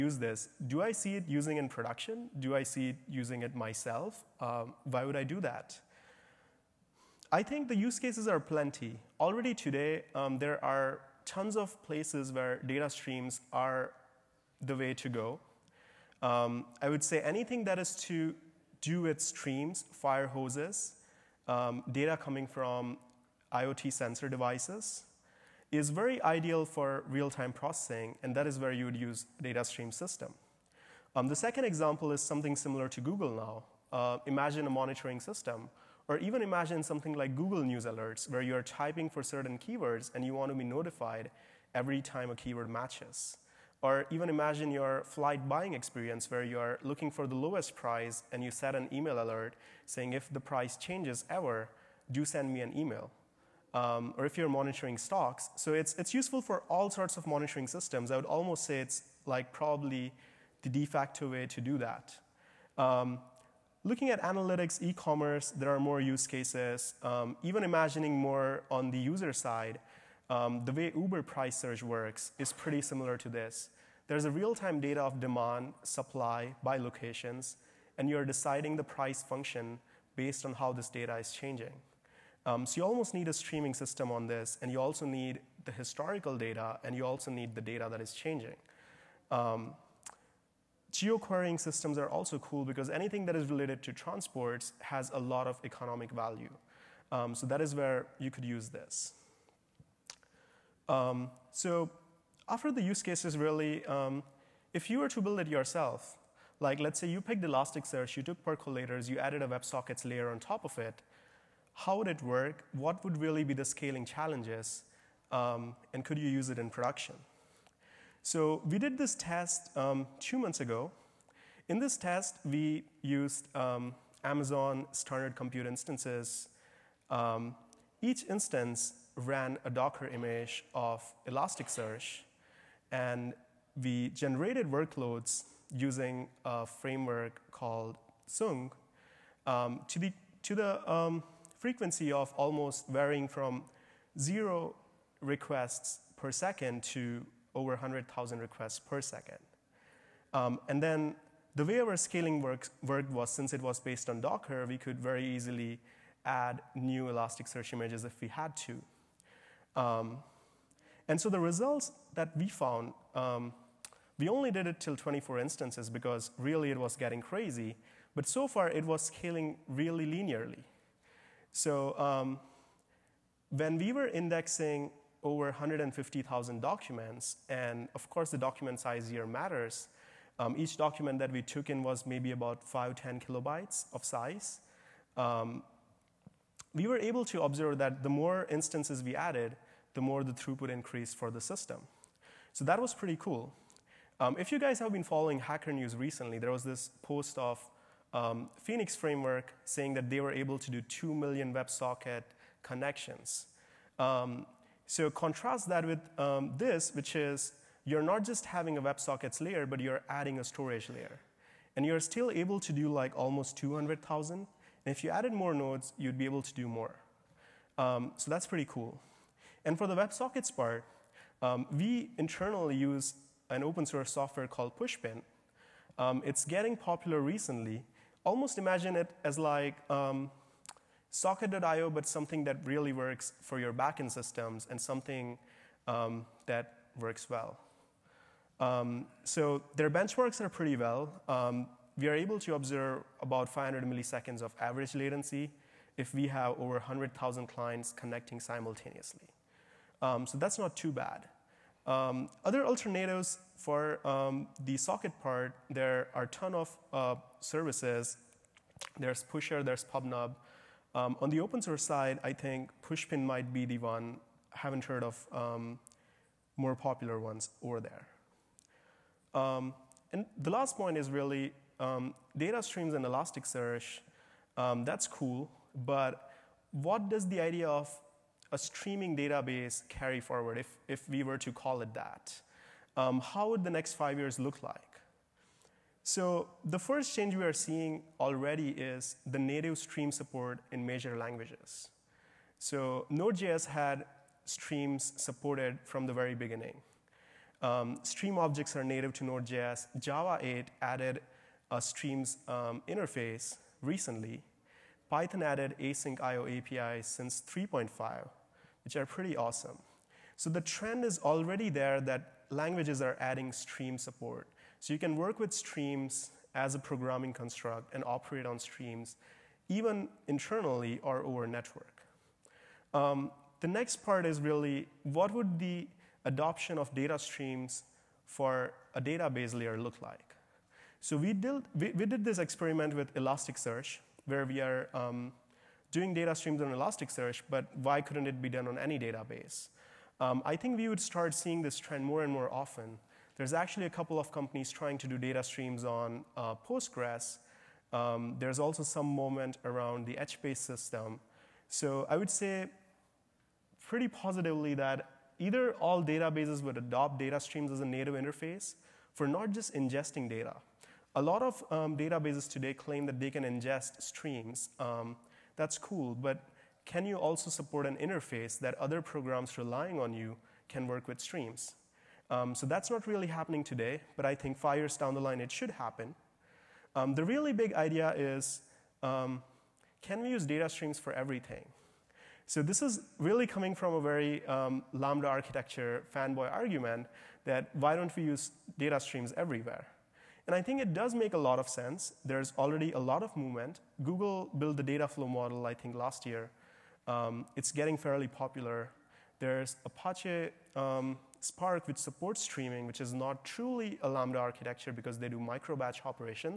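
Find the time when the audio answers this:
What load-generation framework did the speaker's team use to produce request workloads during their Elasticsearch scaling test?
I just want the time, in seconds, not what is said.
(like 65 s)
138 s.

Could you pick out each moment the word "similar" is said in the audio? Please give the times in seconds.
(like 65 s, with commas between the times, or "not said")
32 s, 72 s.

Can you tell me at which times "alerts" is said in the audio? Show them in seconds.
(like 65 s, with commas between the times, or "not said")
37 s, 49 s.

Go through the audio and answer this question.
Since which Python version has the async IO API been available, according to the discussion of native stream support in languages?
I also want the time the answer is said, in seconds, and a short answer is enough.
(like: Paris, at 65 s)
3.5, at 307 s.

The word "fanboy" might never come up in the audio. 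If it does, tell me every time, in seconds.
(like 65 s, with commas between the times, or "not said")
386 s.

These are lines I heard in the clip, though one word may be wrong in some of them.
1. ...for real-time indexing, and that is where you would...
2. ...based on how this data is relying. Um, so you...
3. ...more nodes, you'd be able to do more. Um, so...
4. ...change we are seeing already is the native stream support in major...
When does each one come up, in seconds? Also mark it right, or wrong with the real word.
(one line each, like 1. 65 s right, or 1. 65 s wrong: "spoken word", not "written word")
1. 26 s wrong: "processing", not "indexing"
2. 80 s wrong: "changing", not "relying"
3. 215 s right
4. 287 s right.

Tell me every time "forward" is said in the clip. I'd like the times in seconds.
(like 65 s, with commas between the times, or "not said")
280 s.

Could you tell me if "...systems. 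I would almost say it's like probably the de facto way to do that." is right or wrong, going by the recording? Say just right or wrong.
right.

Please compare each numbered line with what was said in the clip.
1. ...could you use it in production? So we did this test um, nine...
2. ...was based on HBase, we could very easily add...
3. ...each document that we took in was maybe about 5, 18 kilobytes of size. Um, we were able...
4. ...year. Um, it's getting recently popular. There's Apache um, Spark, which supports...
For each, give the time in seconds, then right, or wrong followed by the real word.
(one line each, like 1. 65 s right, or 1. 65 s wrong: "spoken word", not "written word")
1. 116 s wrong: "two", not "nine"
2. 153 s wrong: "Docker", not "HBase"
3. 180 s wrong: "10", not "18"
4. 396 s wrong: "fairly", not "recently".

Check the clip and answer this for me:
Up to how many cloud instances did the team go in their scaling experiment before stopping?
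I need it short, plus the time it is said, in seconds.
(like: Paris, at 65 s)
24, at 164 s.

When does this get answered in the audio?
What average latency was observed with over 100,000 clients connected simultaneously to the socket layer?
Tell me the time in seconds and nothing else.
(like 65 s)
243 s.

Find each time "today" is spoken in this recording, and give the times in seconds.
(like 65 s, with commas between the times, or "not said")
9 s, 362 s, 373 s.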